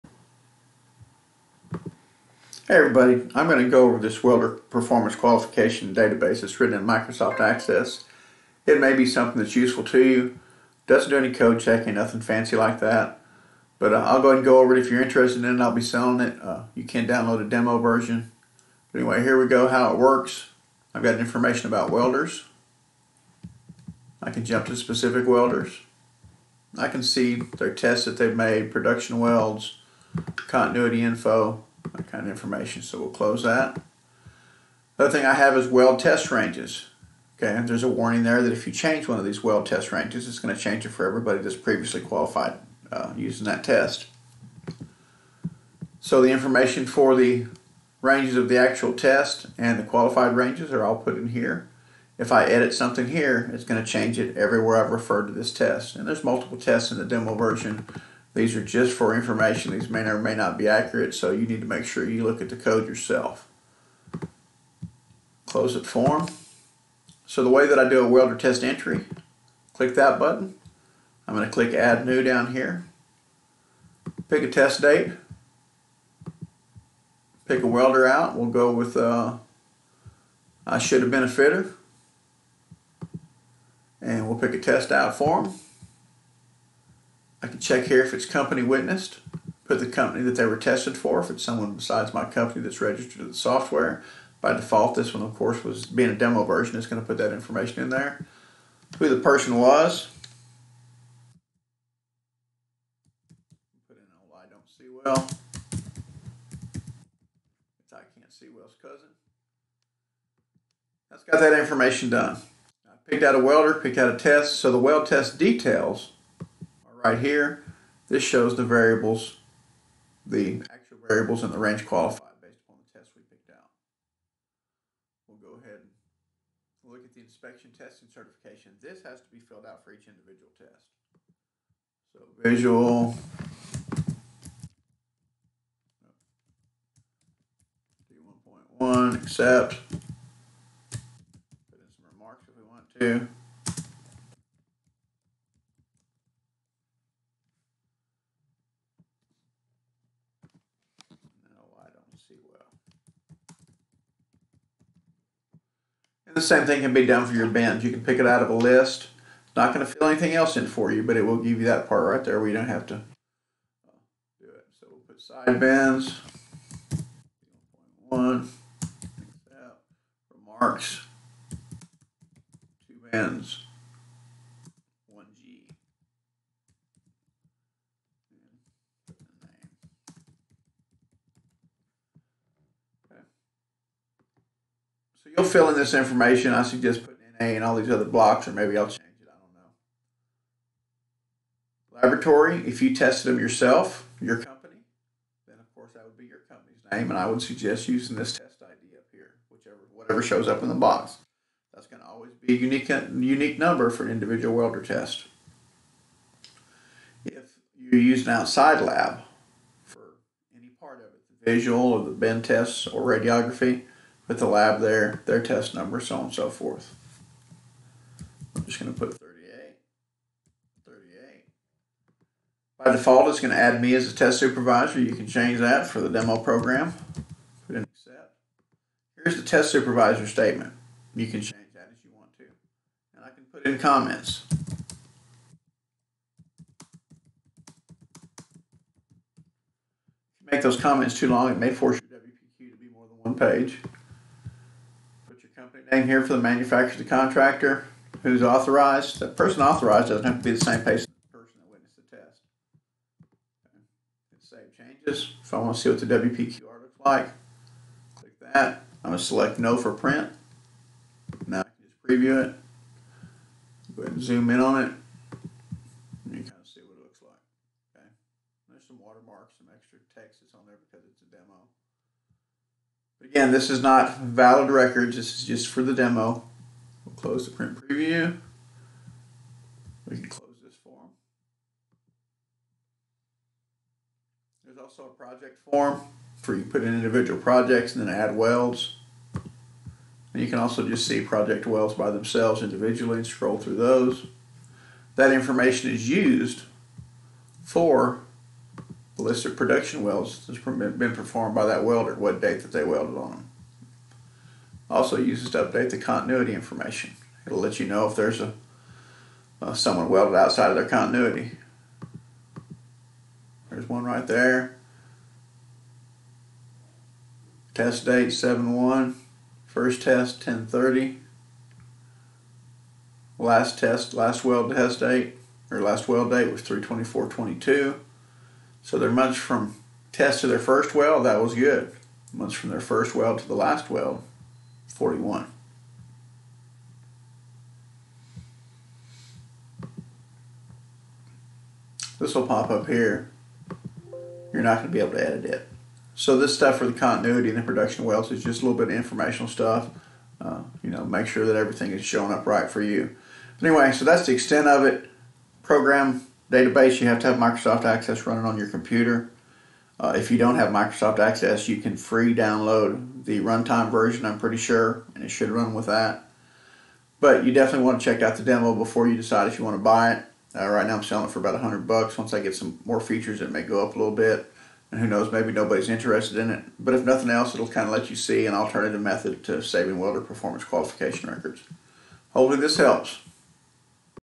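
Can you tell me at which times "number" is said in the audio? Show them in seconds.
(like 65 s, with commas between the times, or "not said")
203 s, 215 s.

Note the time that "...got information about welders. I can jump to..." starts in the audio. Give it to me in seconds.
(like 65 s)
21 s.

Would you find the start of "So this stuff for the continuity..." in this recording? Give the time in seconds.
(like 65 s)
346 s.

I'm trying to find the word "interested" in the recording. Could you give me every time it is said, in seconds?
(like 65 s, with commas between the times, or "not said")
15 s, 375 s.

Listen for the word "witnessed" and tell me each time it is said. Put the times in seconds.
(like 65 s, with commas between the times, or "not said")
88 s, 251 s.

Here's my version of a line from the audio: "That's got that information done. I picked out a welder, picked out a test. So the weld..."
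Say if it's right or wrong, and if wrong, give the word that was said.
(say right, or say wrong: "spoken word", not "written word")
right.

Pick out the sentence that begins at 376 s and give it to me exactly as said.
But if nothing else, it'll kind of let you see an alternative method to saving welder performance qualification records.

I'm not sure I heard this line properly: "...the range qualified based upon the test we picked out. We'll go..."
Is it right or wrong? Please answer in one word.
right.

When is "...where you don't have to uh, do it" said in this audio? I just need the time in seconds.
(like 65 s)
162 s.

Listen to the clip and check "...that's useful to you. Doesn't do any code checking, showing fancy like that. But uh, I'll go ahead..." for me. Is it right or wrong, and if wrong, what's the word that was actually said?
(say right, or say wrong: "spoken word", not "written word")
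wrong: "nothing", not "showing".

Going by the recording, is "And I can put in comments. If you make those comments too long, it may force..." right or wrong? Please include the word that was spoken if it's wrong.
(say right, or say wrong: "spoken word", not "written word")
right.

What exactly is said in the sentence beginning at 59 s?
These may or may not be accurate, so you need to make sure you look at the code yourself.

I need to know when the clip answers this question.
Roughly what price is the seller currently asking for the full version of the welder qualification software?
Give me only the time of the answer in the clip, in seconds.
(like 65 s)
371 s.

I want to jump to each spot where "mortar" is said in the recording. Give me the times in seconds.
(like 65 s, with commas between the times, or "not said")
not said.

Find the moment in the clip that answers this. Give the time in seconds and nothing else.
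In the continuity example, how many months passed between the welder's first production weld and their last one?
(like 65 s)
334 s.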